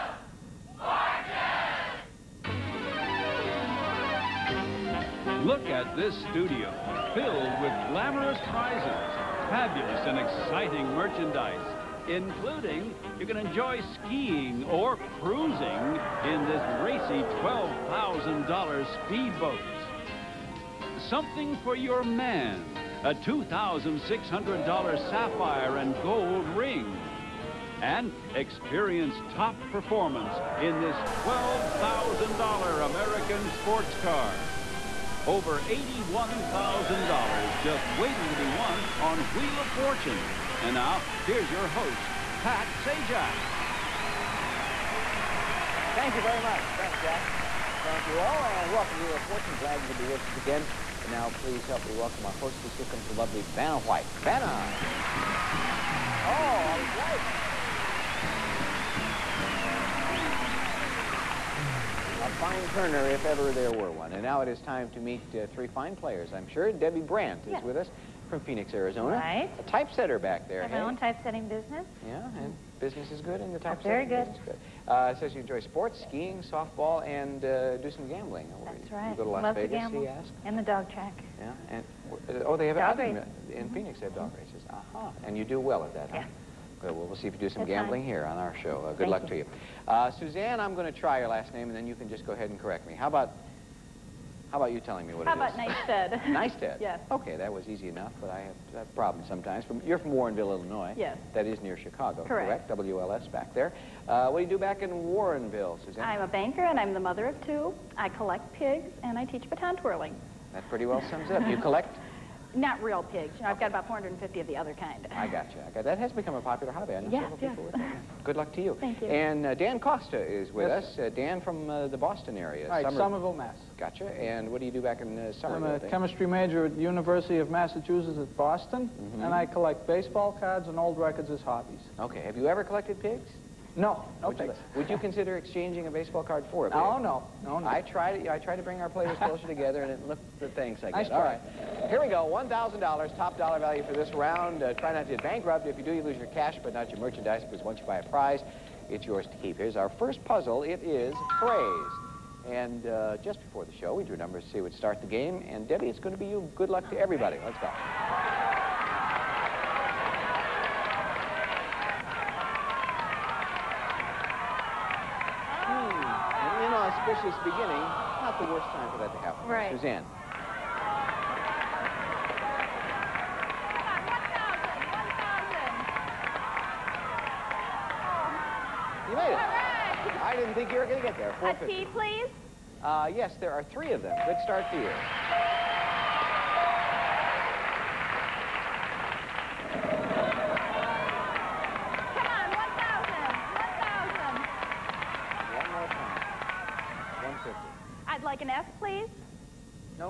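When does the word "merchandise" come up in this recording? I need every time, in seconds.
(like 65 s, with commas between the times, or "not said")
10 s, 146 s.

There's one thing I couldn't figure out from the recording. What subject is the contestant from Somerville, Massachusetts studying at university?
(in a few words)
Chemistry.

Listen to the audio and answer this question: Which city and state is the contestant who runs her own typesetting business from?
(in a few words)
Phoenix, Arizona.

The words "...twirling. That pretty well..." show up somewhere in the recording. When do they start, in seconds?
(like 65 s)
109 s.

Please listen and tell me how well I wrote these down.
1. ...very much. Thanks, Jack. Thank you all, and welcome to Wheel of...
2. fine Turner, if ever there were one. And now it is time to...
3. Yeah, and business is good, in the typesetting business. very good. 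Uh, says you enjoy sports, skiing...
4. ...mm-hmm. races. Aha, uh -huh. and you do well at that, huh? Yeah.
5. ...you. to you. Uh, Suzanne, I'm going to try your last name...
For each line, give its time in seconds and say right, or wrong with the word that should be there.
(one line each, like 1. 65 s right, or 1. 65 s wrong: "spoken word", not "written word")
1. 46 s right
2. 62 s right
3. 72 s right
4. 84 s right
5. 89 s right.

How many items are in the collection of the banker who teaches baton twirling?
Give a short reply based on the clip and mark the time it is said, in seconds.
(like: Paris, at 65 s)
450, at 113 s.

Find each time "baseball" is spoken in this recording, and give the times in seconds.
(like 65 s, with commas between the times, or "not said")
129 s, 135 s.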